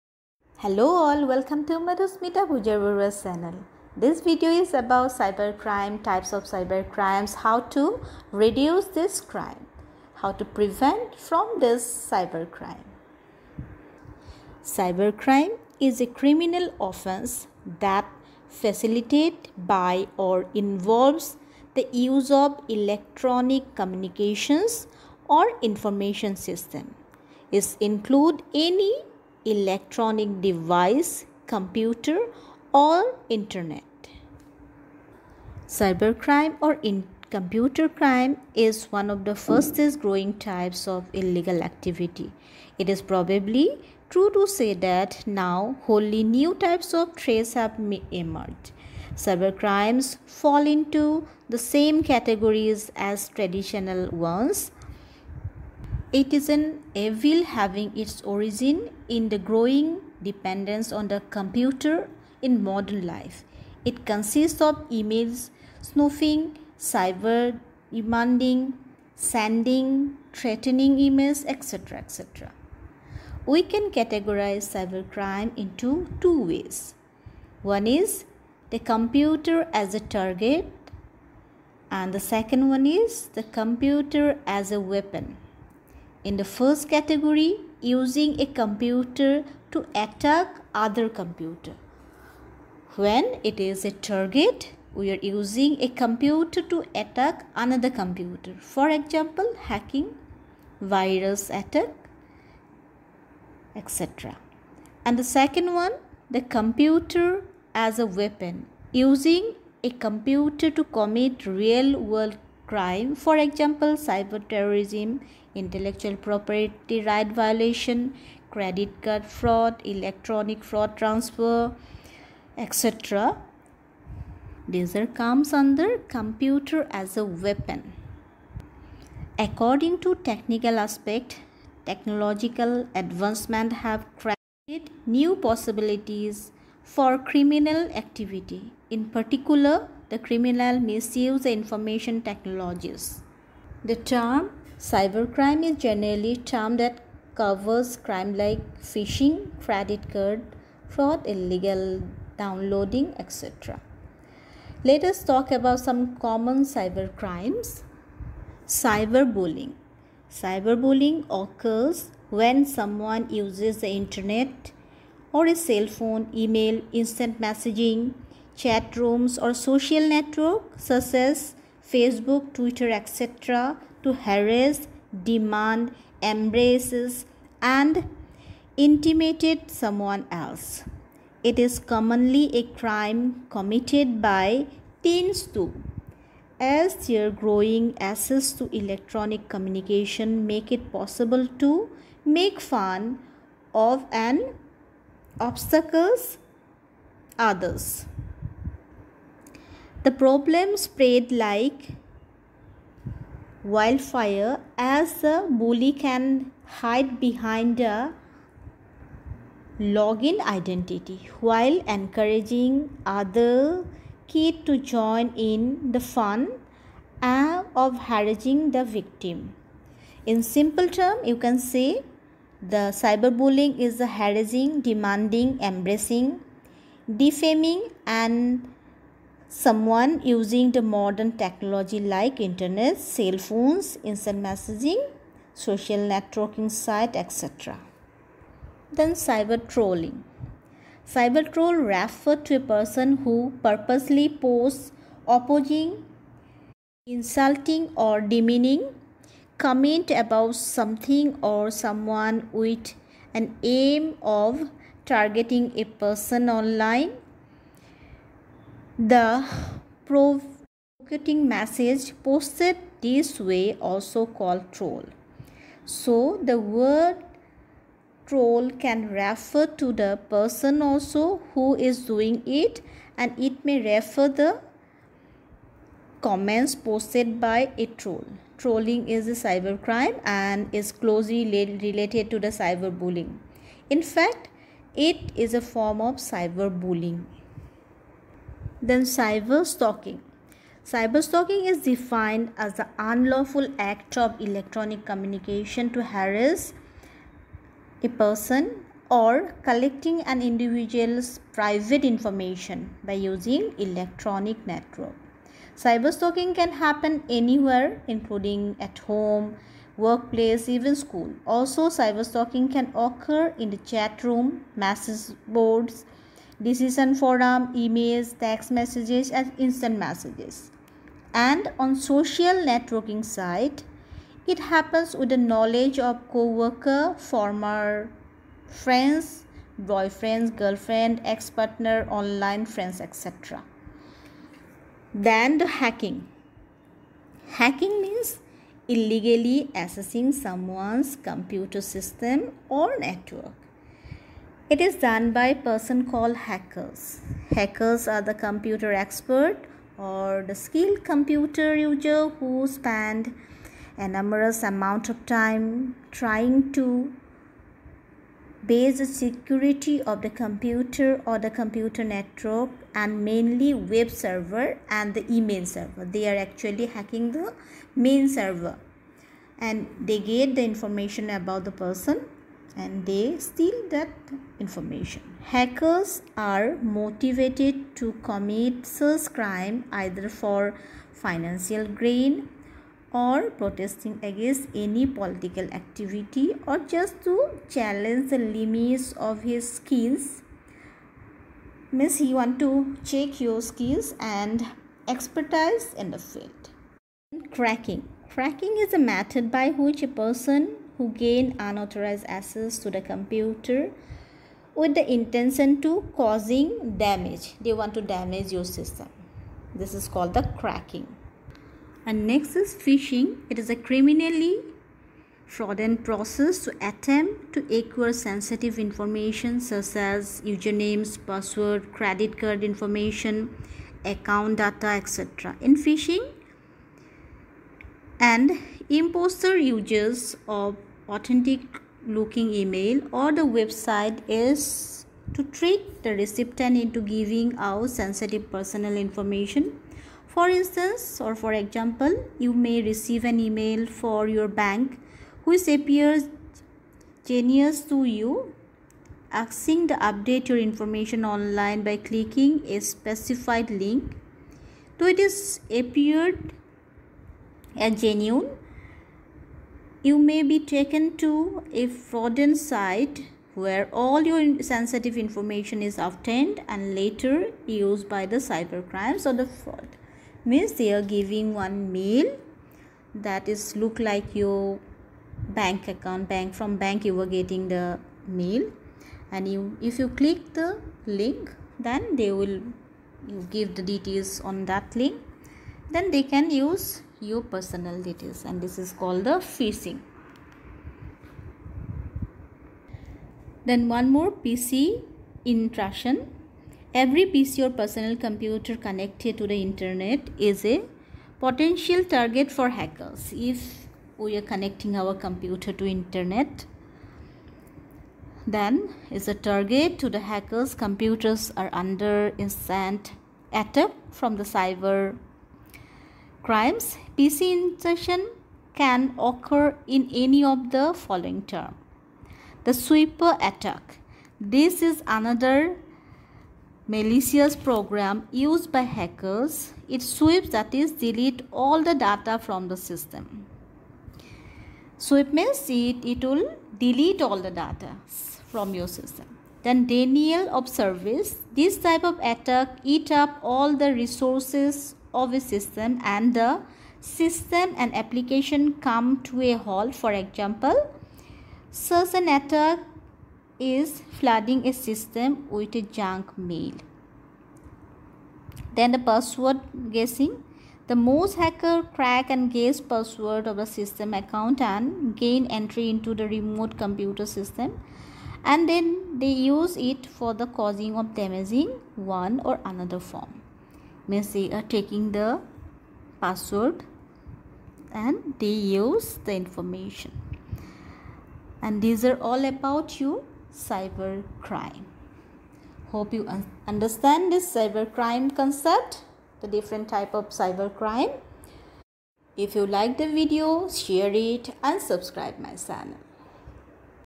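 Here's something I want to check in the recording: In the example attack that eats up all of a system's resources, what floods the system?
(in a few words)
Junk mail.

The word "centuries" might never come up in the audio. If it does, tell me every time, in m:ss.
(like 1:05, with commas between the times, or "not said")
not said.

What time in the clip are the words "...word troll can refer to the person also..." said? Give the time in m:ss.
4:26.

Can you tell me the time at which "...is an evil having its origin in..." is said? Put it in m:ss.
0:56.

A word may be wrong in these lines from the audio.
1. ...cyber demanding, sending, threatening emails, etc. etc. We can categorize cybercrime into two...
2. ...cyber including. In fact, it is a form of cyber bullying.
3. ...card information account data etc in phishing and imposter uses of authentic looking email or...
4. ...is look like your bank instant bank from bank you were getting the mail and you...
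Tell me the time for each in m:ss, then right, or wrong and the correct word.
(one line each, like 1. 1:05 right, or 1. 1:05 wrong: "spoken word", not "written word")
1. 1:06 right
2. 4:42 wrong: "bullying", not "including"
3. 7:02 right
4. 7:53 wrong: "account", not "instant".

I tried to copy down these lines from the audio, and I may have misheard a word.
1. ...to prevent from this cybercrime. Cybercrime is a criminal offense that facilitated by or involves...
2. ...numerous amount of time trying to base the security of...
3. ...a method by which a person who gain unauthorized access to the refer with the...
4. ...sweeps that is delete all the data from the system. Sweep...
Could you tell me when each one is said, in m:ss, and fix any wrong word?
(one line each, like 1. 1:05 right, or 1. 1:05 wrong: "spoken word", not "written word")
1. 0:10 right
2. 5:54 right
3. 6:38 wrong: "computer", not "refer"
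4. 8:50 right.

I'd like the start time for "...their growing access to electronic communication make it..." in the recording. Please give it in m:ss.
3:07.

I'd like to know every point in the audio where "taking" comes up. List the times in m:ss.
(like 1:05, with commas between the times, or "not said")
9:34.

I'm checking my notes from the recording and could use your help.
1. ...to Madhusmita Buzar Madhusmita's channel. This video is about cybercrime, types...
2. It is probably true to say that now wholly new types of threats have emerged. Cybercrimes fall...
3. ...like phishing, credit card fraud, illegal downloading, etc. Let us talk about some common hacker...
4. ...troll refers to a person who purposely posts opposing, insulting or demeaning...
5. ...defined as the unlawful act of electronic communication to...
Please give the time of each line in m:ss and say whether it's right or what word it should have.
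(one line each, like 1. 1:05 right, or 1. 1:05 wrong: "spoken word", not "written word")
1. 0:01 wrong: "Baruah", not "Madhusmita"
2. 0:42 right
3. 2:28 wrong: "cyber", not "hacker"
4. 4:01 right
5. 4:51 right.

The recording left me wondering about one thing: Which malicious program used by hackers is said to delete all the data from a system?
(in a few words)
Sweeper.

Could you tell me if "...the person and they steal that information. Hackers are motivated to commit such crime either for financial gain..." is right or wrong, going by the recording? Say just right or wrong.
right.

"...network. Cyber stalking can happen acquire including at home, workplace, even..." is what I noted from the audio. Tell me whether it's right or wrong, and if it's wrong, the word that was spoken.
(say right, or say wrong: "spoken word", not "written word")
wrong: "anywhere", not "acquire".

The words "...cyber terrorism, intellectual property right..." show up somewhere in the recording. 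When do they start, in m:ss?
1:54.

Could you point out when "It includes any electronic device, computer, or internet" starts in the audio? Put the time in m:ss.
0:27.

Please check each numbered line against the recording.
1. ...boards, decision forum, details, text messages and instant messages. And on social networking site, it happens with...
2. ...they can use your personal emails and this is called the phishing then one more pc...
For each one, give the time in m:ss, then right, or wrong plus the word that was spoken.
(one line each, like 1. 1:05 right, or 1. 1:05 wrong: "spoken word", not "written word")
1. 5:15 wrong: "emails", not "details"
2. 8:06 wrong: "details", not "emails".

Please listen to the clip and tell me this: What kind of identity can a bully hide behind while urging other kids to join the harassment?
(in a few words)
A login identity.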